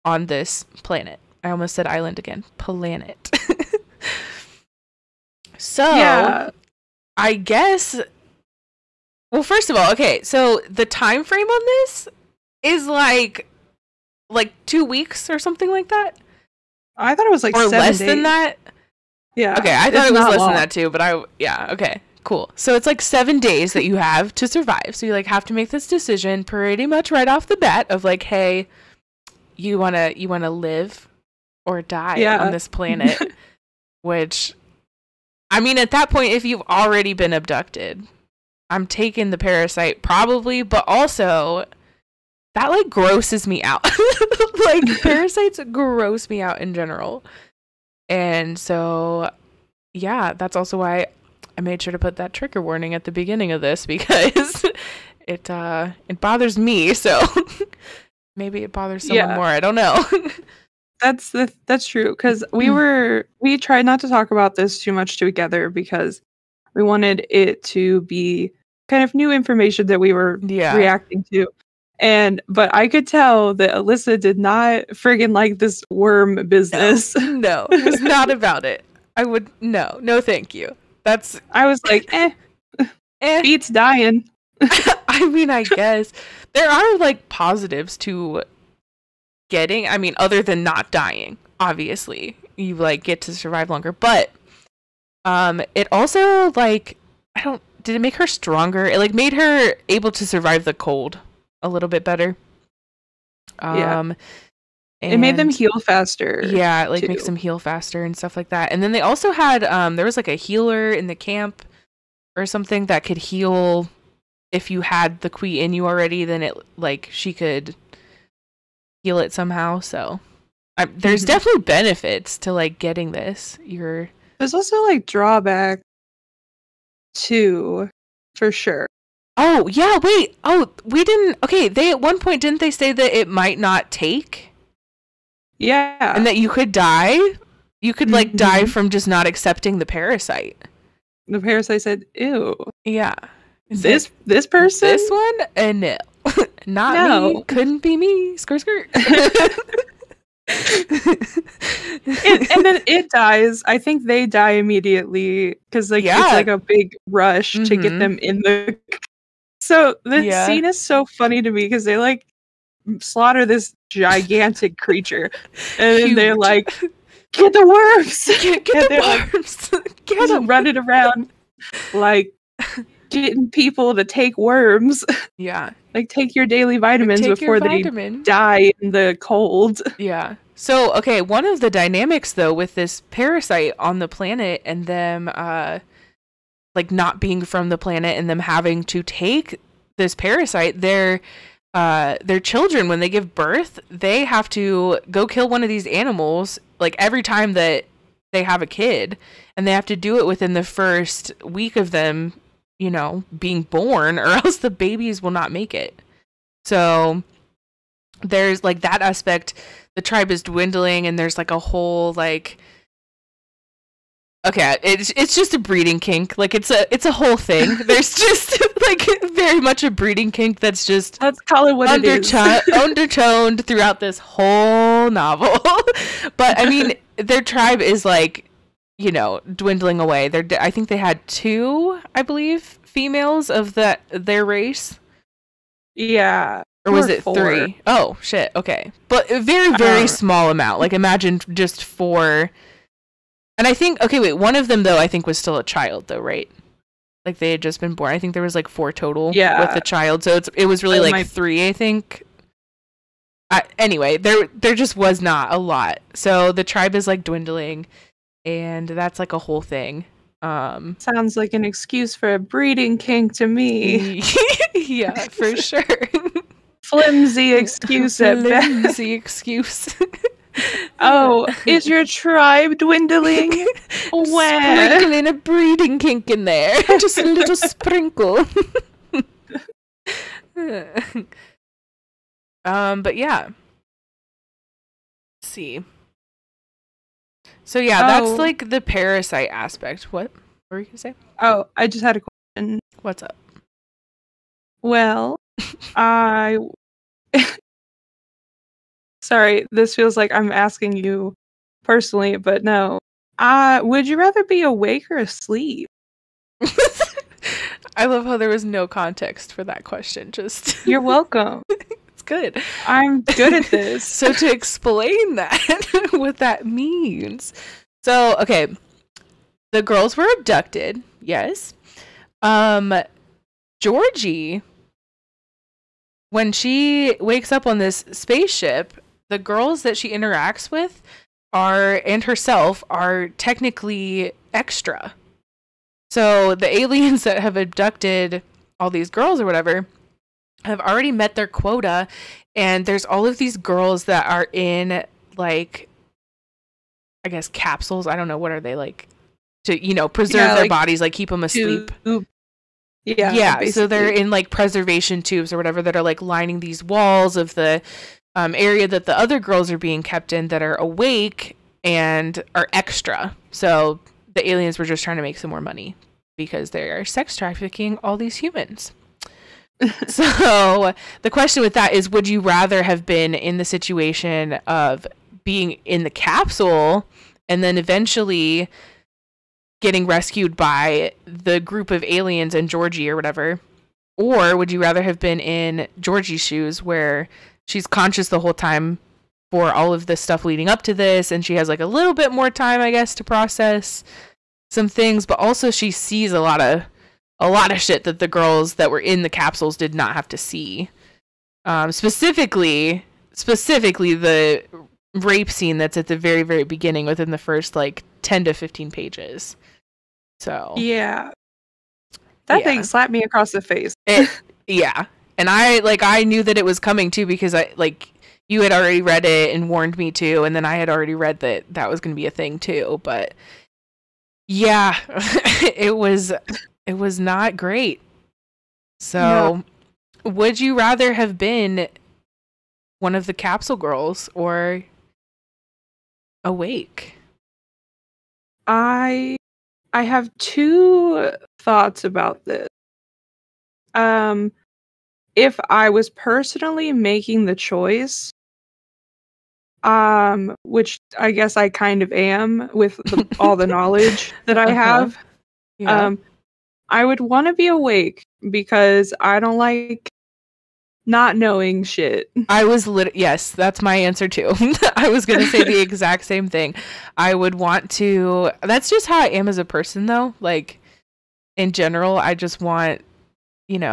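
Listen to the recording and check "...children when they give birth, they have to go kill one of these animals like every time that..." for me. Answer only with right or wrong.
right.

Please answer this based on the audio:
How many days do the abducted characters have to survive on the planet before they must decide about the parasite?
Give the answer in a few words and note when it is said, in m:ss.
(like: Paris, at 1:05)
7, at 0:23.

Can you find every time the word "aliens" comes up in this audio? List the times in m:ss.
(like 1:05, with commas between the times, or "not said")
5:36, 6:04, 6:22.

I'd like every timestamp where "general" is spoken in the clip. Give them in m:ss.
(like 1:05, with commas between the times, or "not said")
0:46, 7:51.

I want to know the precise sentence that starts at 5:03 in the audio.
Uh, would you rather be awake or asleep?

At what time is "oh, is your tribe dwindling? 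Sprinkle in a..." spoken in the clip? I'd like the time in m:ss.
4:30.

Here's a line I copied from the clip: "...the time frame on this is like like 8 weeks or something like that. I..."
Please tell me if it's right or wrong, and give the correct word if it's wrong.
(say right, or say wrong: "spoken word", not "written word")
wrong: "2", not "8".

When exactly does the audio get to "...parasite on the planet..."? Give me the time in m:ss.
3:03.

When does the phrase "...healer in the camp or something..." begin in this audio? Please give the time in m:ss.
1:50.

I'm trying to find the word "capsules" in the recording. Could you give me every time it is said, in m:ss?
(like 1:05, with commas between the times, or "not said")
5:47, 6:16, 6:39, 7:13.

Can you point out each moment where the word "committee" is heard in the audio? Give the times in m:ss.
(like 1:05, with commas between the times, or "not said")
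not said.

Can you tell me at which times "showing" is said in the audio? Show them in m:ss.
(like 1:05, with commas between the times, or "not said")
not said.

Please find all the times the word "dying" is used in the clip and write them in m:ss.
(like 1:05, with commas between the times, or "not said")
1:23, 1:30.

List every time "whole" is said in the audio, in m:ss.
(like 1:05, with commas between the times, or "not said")
3:31, 3:37, 3:44, 4:19, 6:28.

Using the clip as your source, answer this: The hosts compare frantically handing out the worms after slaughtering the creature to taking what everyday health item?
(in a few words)
daily vitamins.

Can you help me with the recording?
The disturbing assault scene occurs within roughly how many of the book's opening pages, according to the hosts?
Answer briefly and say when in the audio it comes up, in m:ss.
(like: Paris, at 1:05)
10 to 15, at 6:48.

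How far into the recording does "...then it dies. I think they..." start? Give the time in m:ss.
2:32.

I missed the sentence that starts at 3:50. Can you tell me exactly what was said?
They're I think they had two, I believe, females of that their race.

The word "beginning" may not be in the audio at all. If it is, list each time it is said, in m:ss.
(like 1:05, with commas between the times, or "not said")
0:53, 6:46.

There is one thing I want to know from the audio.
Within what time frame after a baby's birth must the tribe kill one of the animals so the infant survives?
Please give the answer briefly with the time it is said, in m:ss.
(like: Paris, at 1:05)
first week, at 3:20.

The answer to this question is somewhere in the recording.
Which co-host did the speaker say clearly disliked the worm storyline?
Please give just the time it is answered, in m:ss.
1:13.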